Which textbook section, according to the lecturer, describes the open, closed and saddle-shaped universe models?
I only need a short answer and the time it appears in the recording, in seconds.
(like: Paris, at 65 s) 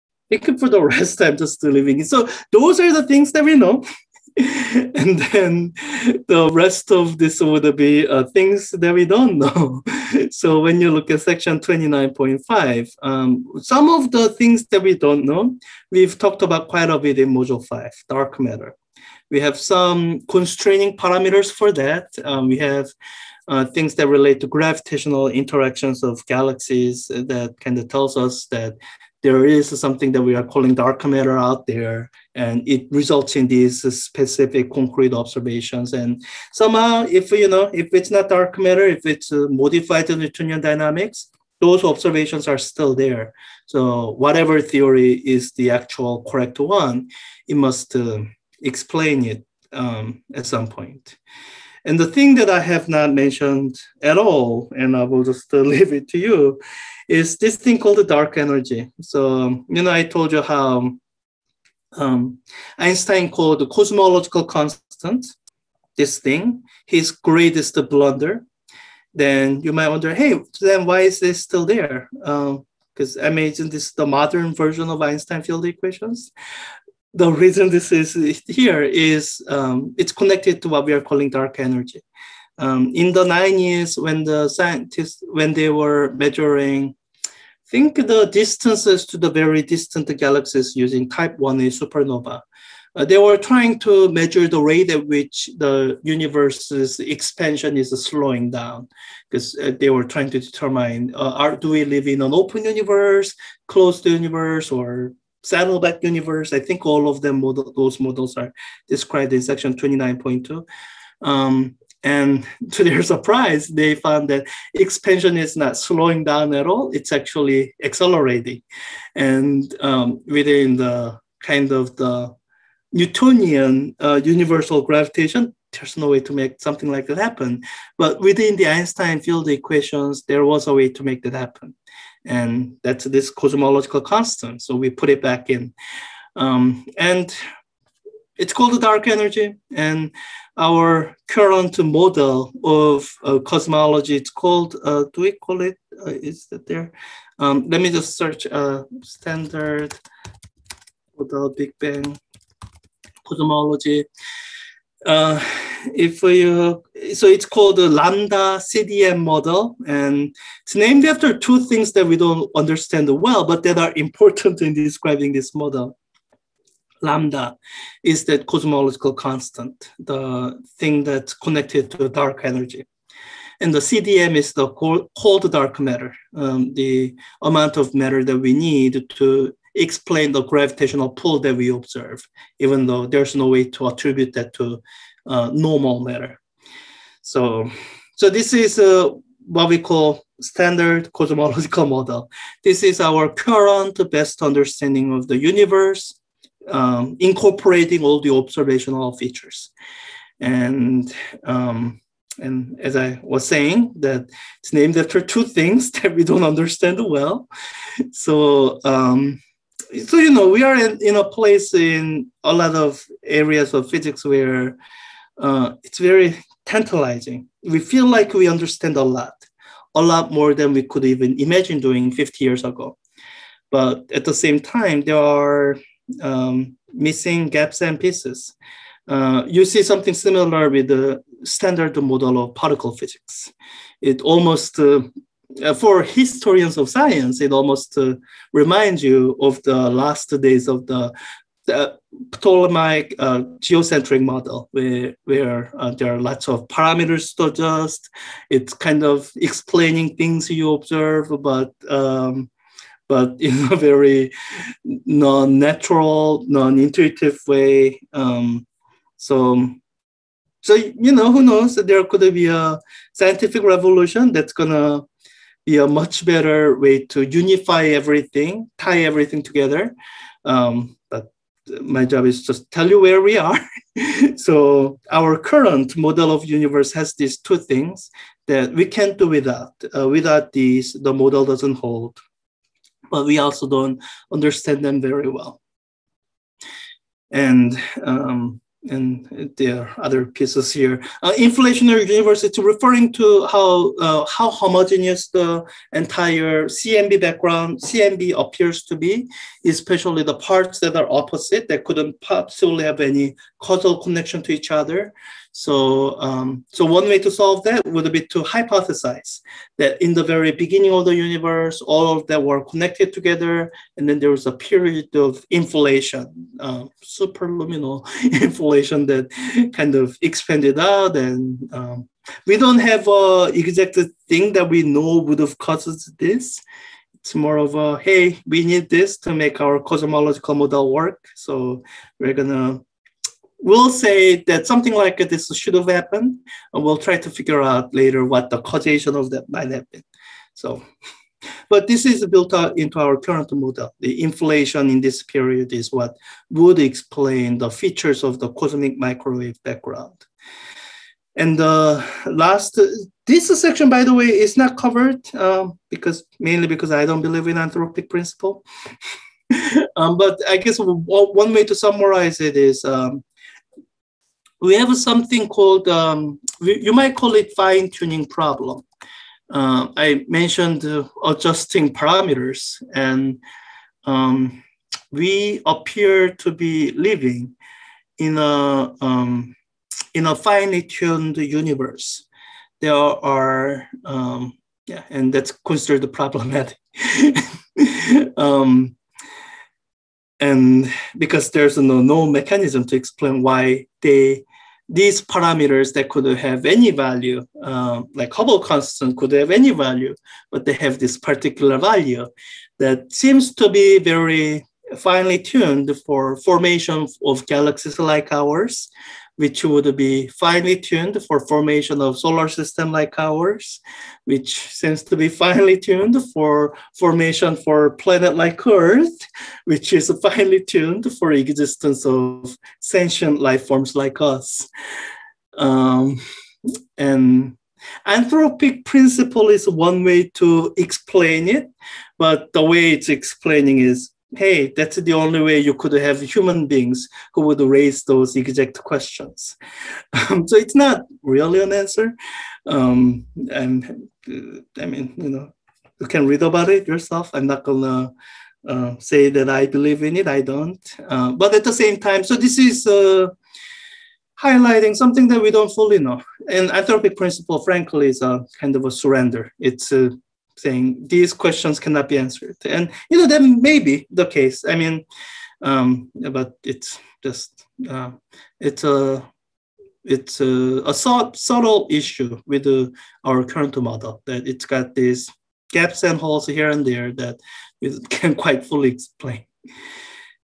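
29.2, at 109 s.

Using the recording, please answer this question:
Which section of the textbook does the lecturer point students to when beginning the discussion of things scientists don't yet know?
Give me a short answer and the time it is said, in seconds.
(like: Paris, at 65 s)
29.5, at 11 s.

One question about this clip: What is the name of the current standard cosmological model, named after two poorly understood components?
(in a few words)
Lambda CDM model.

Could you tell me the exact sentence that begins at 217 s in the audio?
We feel like we understand a lot, a lot more than we could even imagine doing 50 years ago.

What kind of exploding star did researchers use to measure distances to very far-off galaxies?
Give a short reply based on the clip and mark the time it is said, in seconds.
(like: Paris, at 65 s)
Type 1A supernova, at 91 s.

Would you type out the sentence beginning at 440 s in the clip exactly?
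Um, so it's not really an answer.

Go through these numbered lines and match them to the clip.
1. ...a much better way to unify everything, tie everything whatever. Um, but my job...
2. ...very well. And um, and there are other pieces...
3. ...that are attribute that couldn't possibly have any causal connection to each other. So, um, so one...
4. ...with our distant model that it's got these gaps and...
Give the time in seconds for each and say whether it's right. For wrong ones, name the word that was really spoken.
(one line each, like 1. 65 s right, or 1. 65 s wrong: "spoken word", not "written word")
1. 265 s wrong: "together", not "whatever"
2. 285 s right
3. 300 s wrong: "opposite", not "attribute"
4. 472 s wrong: "current", not "distant".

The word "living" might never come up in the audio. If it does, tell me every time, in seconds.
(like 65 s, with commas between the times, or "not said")
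1 s, 376 s.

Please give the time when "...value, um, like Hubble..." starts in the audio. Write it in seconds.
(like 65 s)
396 s.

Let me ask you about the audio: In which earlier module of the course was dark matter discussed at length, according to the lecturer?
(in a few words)
Module 5.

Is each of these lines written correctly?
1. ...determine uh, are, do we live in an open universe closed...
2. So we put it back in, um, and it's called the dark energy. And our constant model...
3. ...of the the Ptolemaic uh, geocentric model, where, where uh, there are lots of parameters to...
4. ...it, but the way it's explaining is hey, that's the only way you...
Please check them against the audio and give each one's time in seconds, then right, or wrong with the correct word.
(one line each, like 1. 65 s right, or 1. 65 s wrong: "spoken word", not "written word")
1. 100 s right
2. 134 s wrong: "current", not "constant"
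3. 240 s right
4. 431 s right.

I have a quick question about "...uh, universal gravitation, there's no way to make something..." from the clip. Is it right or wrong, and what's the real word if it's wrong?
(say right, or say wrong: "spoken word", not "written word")
right.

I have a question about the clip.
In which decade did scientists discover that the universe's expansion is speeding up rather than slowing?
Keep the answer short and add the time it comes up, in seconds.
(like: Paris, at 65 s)
The 90s, at 82 s.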